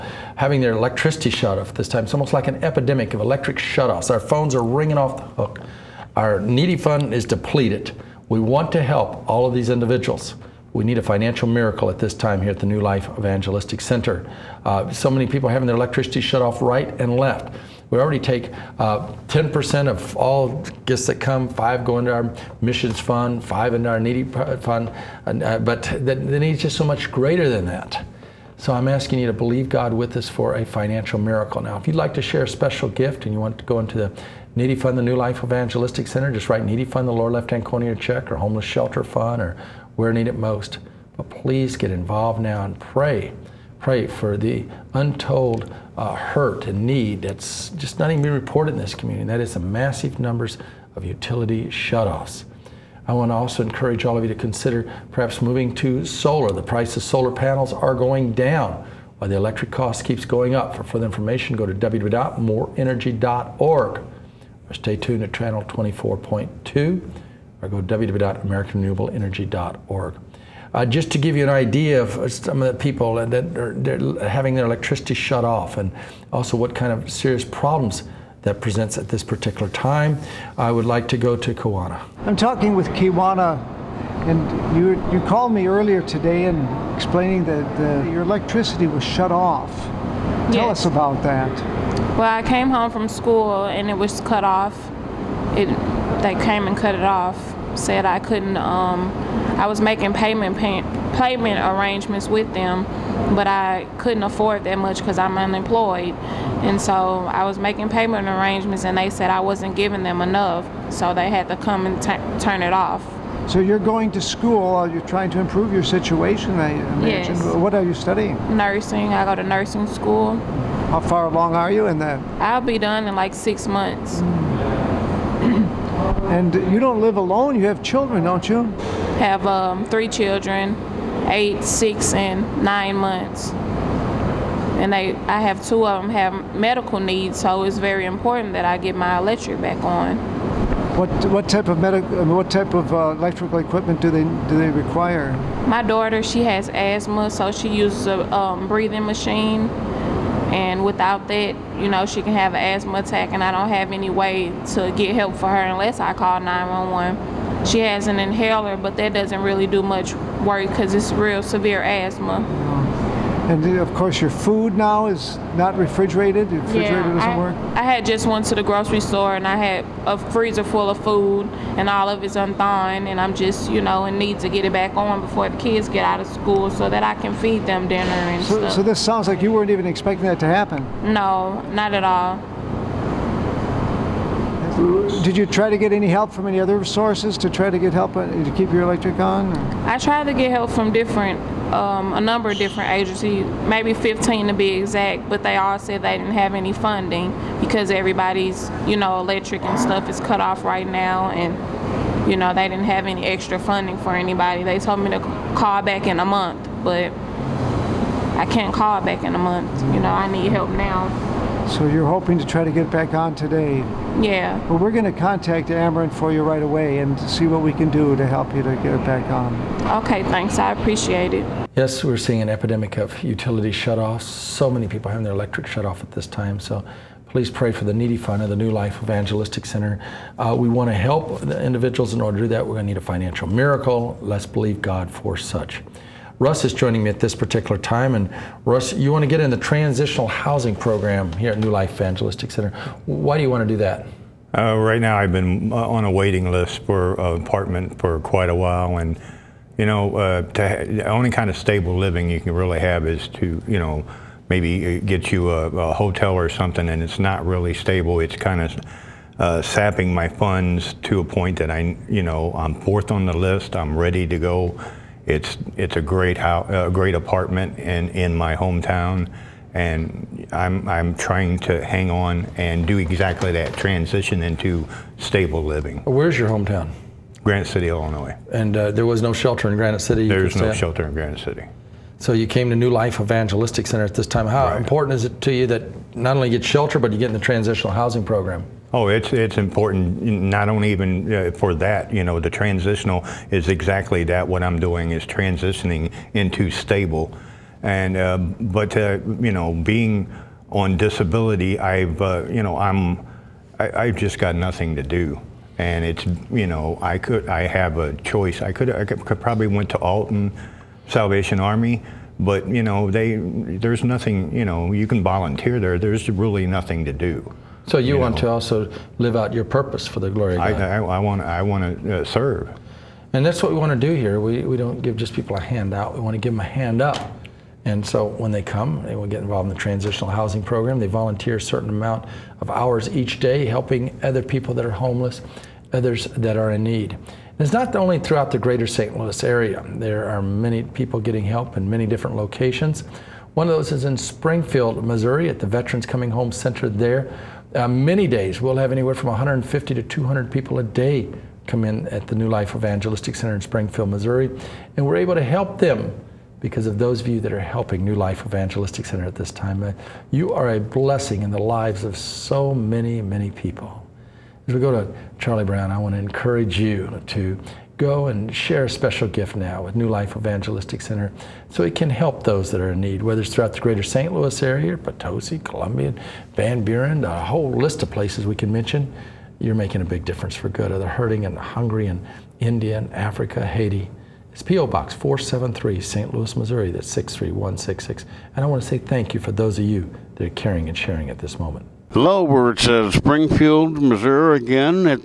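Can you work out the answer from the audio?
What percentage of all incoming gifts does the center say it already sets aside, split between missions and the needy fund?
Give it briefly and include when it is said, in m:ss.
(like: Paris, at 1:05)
10%, at 0:19.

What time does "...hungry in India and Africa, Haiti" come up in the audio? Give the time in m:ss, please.
6:21.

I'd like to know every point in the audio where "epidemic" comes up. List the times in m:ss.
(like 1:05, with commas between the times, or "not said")
0:02, 3:42.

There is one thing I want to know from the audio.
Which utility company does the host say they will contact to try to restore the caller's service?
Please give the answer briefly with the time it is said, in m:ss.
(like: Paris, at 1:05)
Ameren, at 3:35.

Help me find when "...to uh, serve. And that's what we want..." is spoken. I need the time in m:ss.
5:22.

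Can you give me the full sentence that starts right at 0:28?
So I'm asking you to believe God with us for a financial miracle.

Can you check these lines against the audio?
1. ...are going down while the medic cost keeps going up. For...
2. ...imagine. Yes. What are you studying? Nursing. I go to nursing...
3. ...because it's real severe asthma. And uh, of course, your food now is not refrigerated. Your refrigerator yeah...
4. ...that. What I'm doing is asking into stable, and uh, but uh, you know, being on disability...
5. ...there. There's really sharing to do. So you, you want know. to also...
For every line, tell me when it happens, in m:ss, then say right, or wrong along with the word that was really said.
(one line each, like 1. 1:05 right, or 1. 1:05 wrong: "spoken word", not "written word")
1. 0:57 wrong: "electric", not "medic"
2. 1:56 right
3. 2:40 right
4. 4:54 wrong: "transitioning", not "asking"
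5. 5:15 wrong: "nothing", not "sharing".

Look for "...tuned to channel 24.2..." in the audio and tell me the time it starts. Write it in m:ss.
1:04.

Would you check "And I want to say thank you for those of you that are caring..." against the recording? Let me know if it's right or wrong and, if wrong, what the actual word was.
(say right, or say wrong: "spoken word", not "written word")
right.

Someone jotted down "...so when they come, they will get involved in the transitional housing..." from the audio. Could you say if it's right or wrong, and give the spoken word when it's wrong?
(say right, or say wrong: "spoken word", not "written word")
right.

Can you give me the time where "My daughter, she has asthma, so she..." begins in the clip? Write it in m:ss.
2:25.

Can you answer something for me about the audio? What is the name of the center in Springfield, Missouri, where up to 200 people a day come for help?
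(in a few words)
Veterans Coming Home Center.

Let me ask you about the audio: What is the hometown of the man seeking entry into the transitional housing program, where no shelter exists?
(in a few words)
Granite City, Illinois.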